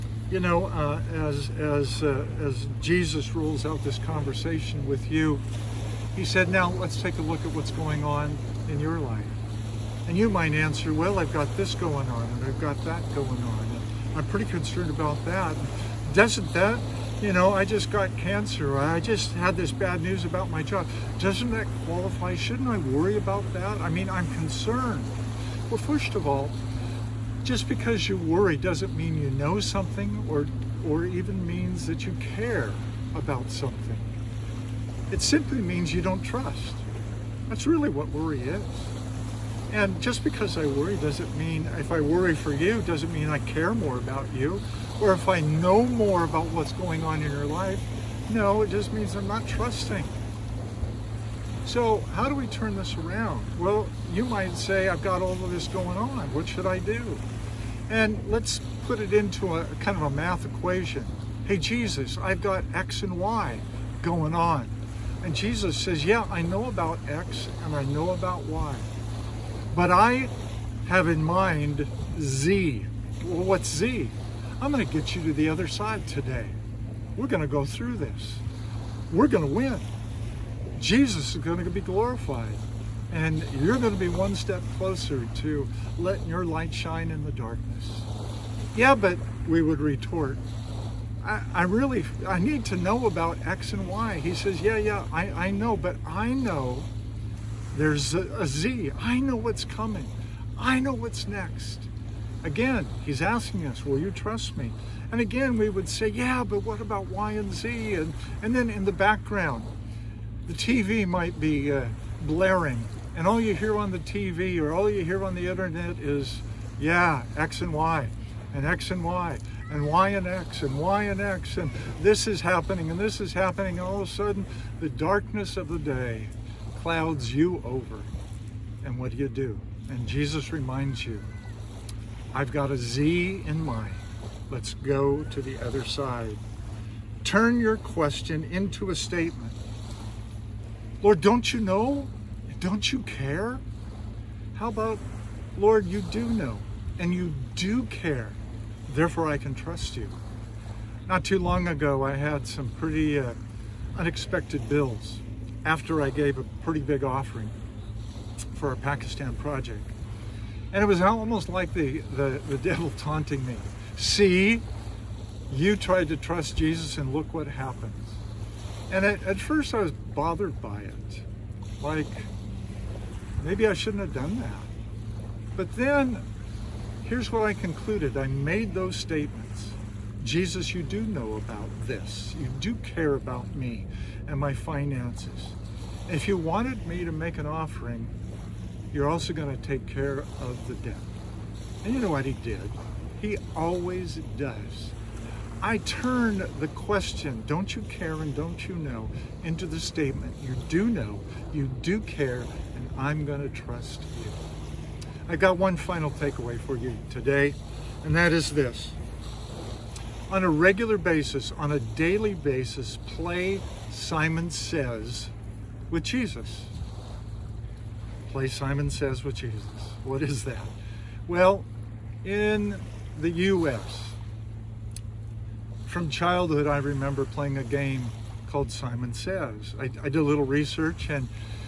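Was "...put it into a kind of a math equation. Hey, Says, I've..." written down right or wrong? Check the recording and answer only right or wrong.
wrong.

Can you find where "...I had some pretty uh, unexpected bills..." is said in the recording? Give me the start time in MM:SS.
02:32.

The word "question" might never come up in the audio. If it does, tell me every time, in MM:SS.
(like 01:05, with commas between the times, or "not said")
02:17, 03:16.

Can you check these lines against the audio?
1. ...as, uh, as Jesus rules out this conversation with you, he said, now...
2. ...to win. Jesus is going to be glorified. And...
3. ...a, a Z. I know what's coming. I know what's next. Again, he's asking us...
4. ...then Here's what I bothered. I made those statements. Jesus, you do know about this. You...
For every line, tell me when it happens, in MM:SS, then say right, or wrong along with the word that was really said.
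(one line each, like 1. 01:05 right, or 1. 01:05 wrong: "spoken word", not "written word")
1. 00:01 right
2. 01:19 right
3. 01:38 right
4. 02:55 wrong: "concluded", not "bothered".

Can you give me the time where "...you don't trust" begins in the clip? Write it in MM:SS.
00:35.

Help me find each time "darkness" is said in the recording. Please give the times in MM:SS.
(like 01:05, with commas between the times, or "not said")
01:27, 02:04.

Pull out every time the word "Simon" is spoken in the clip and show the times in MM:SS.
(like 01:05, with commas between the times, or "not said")
03:33, 03:38, 03:48.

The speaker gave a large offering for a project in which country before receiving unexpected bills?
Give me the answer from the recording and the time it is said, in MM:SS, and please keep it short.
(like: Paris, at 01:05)
Pakistan, at 02:38.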